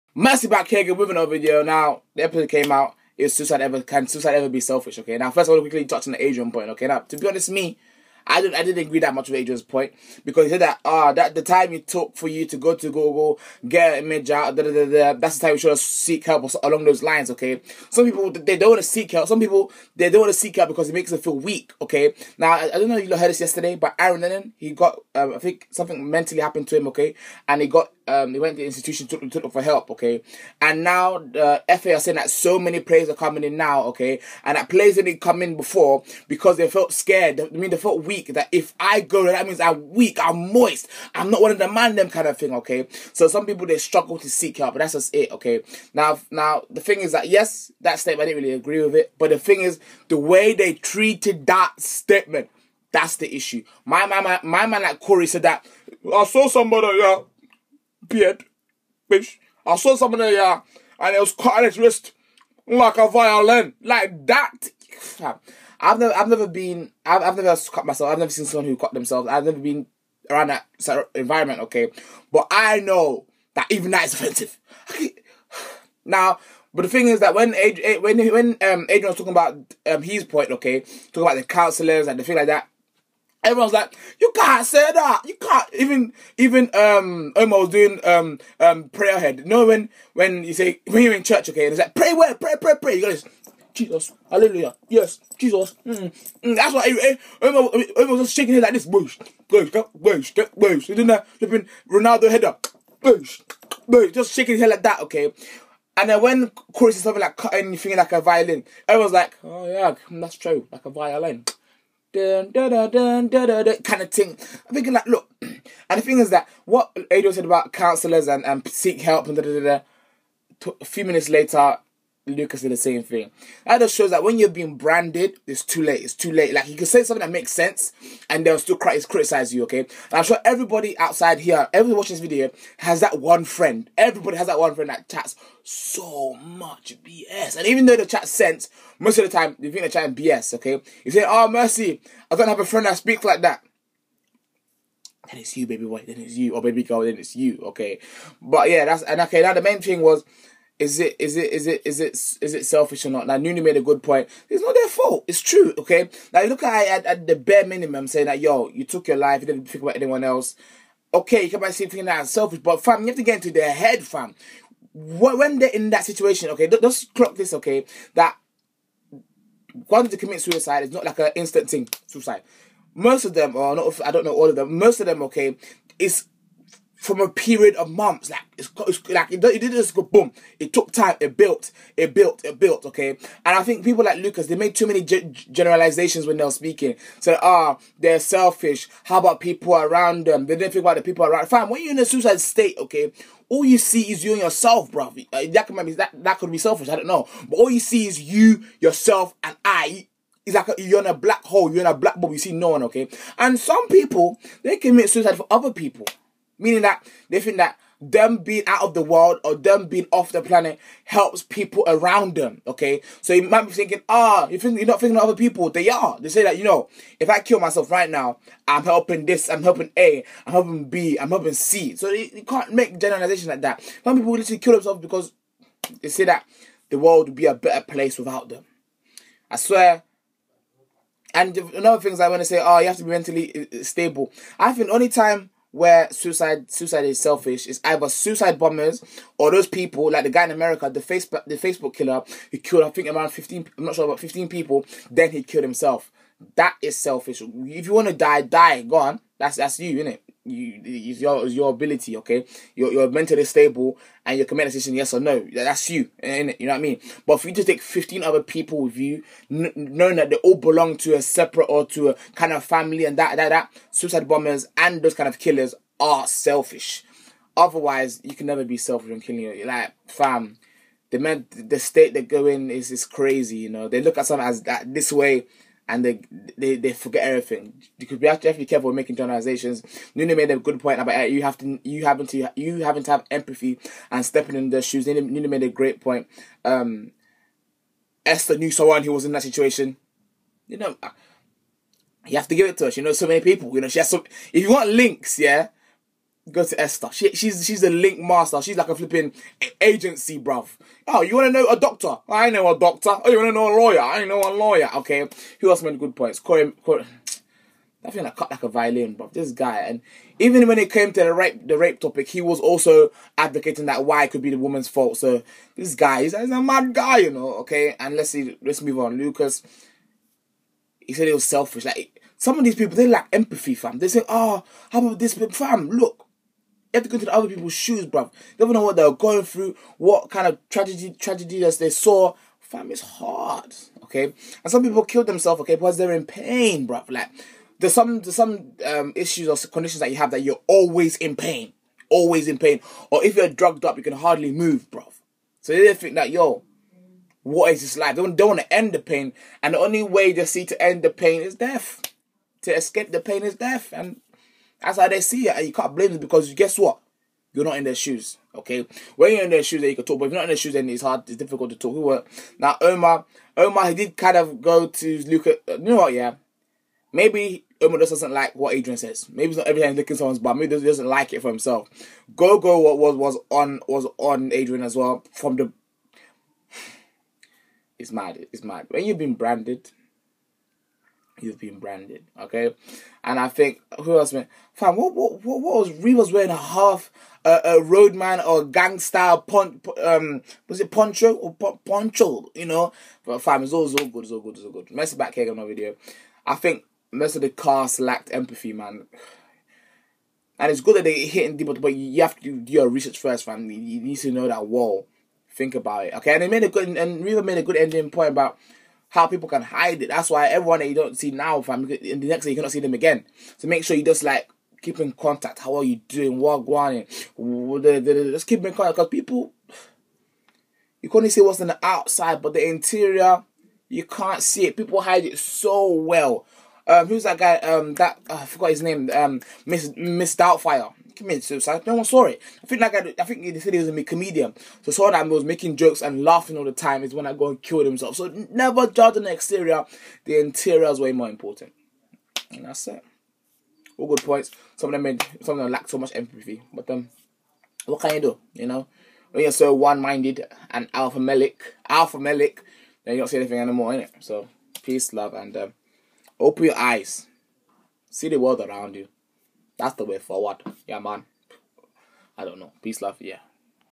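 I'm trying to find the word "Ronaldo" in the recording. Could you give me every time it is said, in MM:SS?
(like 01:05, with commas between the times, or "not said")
01:41.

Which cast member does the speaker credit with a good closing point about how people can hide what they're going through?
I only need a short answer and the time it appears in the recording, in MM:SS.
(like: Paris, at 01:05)
Reba, at 06:47.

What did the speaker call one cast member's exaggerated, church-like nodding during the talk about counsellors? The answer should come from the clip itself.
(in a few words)
prayer head.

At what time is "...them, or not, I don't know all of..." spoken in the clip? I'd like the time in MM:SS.
02:53.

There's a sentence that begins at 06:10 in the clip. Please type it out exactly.
Maybe he doesn't like it for himself.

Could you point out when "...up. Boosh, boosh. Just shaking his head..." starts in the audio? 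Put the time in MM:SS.
01:42.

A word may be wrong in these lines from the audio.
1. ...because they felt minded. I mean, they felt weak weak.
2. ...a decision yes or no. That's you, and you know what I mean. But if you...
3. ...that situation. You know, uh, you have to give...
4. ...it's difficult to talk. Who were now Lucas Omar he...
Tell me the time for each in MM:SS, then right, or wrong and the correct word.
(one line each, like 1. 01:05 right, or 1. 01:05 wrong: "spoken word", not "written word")
1. 00:36 wrong: "scared", not "minded"
2. 04:14 right
3. 04:49 right
4. 06:01 wrong: "Omar", not "Lucas".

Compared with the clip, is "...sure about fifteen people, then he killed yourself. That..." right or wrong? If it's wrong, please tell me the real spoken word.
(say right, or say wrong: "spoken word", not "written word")
wrong: "himself", not "yourself".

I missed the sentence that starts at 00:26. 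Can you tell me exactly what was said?
Okay, and he got um, he went to the institution took took for help, okay?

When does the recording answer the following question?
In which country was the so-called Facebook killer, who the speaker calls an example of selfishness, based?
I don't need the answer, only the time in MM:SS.
04:00.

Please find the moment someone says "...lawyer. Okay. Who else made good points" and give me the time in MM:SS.
05:04.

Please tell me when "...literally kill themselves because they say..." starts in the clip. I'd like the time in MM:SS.
03:44.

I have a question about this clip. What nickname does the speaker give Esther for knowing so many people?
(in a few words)
link master.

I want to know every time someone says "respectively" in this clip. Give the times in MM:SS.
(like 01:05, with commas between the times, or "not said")
not said.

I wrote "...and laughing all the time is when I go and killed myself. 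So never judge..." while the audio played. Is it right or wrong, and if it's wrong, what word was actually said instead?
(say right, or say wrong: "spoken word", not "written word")
wrong: "himself", not "myself".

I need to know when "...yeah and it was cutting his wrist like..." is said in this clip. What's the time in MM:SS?
01:00.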